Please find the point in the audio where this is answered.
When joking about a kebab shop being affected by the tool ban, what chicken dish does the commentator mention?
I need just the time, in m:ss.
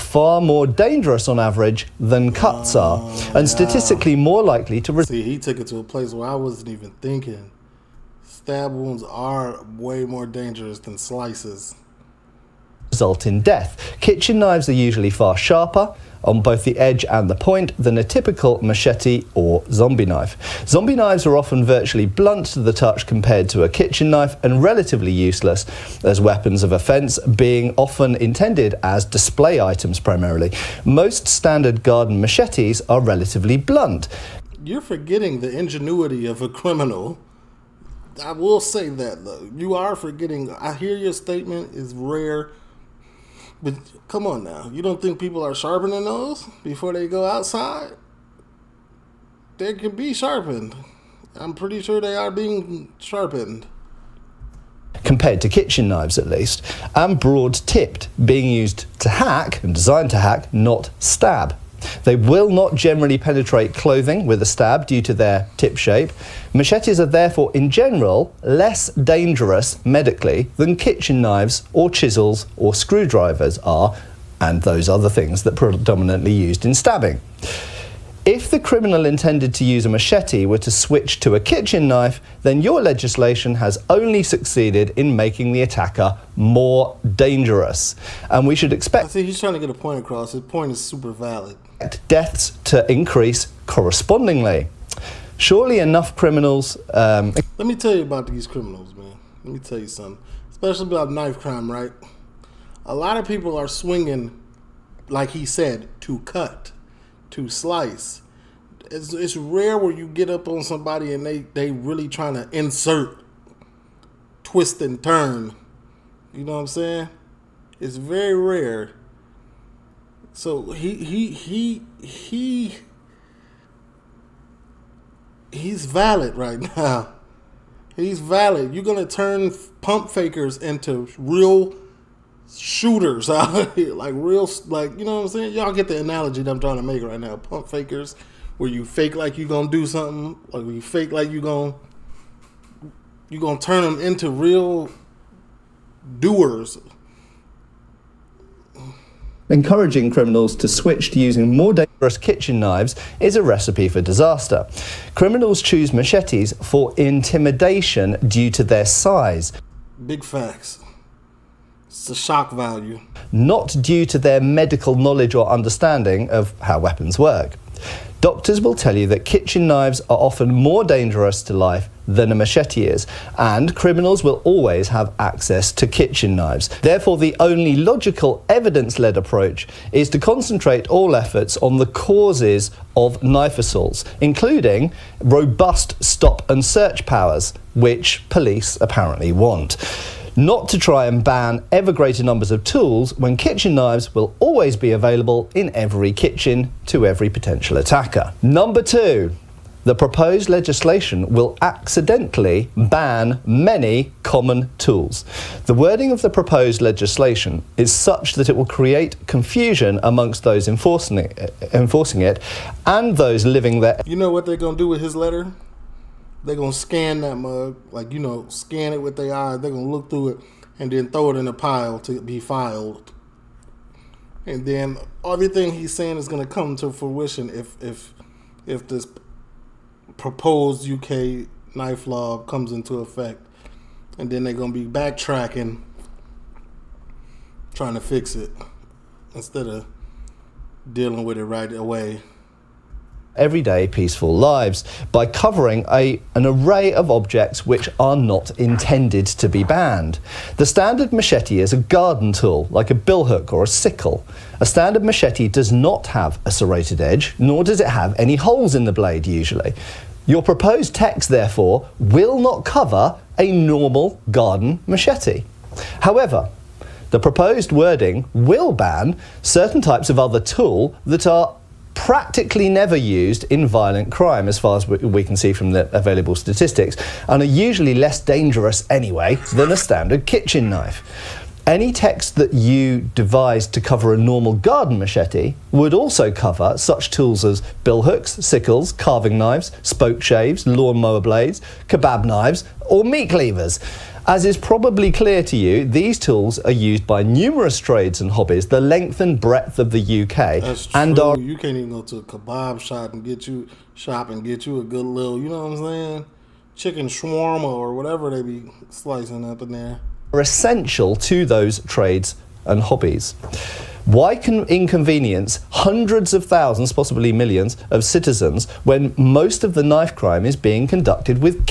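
5:06.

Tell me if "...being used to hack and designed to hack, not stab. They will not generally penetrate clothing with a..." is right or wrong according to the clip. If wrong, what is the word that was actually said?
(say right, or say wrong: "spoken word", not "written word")
right.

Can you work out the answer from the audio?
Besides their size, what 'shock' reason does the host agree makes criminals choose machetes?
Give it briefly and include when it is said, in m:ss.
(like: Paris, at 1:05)
shock value, at 2:42.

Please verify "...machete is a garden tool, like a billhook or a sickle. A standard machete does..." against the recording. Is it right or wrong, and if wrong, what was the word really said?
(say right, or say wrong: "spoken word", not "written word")
right.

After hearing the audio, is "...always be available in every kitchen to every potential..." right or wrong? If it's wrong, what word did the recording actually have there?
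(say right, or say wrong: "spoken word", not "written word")
right.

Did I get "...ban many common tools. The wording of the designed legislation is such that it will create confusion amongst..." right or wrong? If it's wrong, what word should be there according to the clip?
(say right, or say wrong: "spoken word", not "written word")
wrong: "proposed", not "designed".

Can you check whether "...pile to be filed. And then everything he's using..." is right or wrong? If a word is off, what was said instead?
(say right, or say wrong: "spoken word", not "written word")
wrong: "saying", not "using".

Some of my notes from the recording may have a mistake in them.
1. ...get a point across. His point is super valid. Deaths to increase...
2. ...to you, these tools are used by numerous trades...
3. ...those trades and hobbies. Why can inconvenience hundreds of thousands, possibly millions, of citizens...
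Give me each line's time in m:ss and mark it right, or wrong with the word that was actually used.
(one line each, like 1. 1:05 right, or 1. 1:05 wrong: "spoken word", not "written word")
1. 1:29 right
2. 4:55 right
3. 5:11 right.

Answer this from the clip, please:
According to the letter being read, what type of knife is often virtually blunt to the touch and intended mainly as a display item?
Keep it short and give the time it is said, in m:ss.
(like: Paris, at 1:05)
Zombie knives, at 0:20.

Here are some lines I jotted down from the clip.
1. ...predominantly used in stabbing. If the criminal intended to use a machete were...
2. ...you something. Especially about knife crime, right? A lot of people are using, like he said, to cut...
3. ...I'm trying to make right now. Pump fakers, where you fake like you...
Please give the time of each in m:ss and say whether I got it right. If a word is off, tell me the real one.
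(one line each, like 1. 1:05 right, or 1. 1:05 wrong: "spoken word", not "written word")
1. 1:15 right
2. 1:39 wrong: "swinging", not "using"
3. 2:16 right.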